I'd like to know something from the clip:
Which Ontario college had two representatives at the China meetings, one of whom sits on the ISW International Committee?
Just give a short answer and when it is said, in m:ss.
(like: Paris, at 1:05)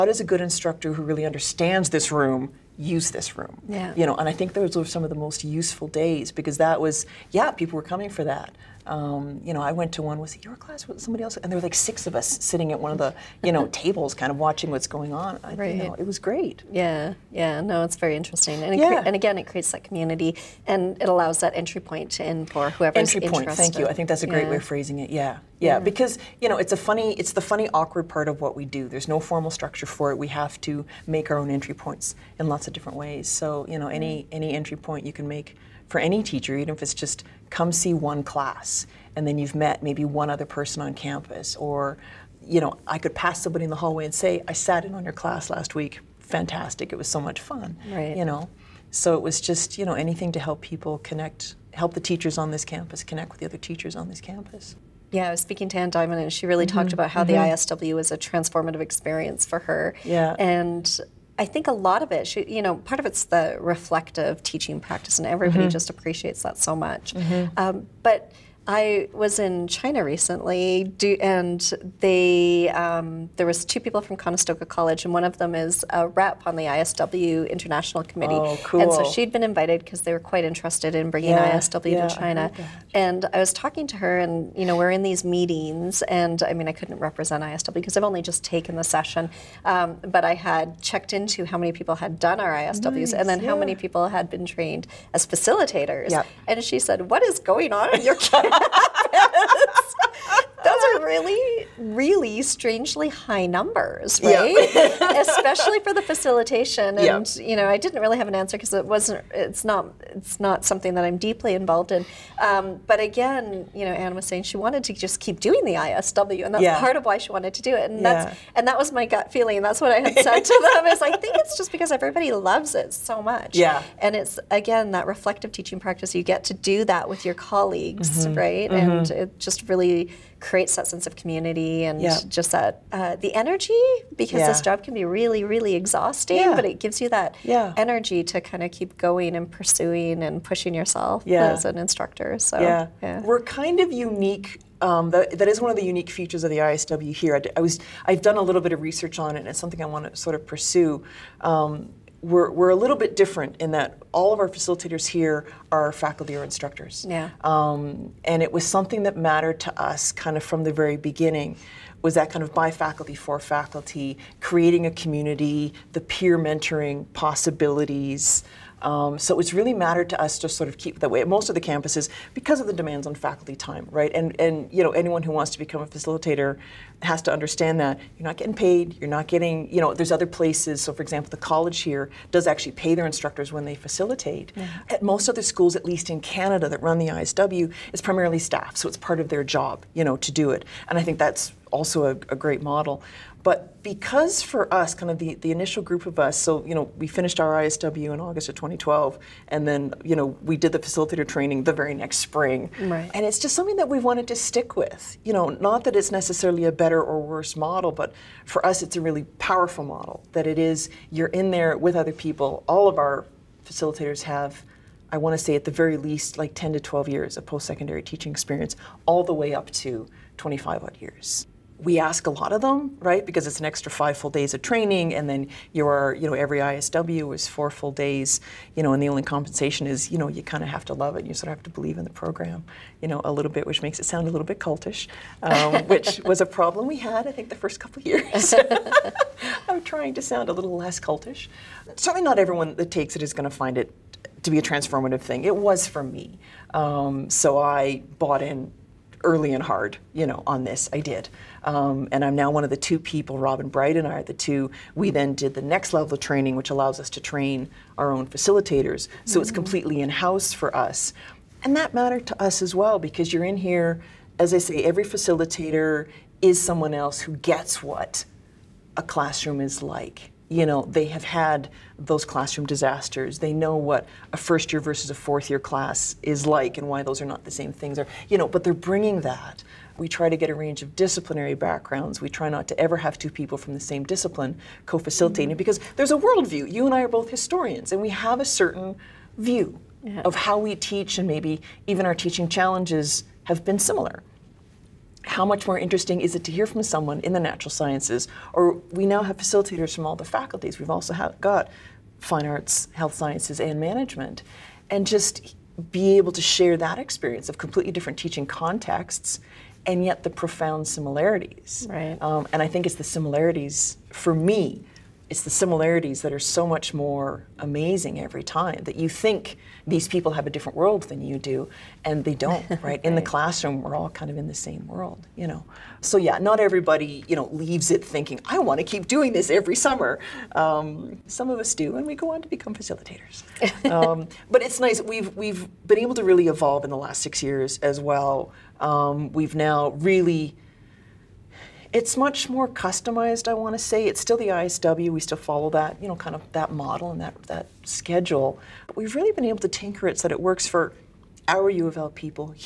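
Conestoga College, at 1:14.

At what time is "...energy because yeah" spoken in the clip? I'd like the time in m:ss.
2:13.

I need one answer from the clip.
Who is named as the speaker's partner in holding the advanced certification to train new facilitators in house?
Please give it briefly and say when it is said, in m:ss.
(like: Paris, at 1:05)
Robin Bright, at 4:13.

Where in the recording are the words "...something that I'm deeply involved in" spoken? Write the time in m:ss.
1:50.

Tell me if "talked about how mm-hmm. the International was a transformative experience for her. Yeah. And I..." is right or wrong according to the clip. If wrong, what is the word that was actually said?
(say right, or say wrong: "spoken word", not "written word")
wrong: "ISW", not "International".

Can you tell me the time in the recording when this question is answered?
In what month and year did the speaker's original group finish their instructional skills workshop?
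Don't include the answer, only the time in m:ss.
3:18.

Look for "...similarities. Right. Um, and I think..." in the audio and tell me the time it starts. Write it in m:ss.
5:10.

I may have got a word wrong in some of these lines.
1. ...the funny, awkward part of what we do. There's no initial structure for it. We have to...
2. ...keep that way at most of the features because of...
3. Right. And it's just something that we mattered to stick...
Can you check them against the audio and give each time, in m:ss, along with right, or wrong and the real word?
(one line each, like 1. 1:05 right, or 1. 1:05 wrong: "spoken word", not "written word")
1. 0:27 wrong: "formal", not "initial"
2. 2:50 wrong: "campuses", not "features"
3. 3:22 wrong: "wanted", not "mattered".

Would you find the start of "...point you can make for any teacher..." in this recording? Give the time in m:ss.
0:34.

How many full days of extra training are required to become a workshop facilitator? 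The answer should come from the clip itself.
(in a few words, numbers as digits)
5.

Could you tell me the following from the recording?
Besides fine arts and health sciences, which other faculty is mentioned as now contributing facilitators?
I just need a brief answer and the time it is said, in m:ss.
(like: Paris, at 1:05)
management, at 5:03.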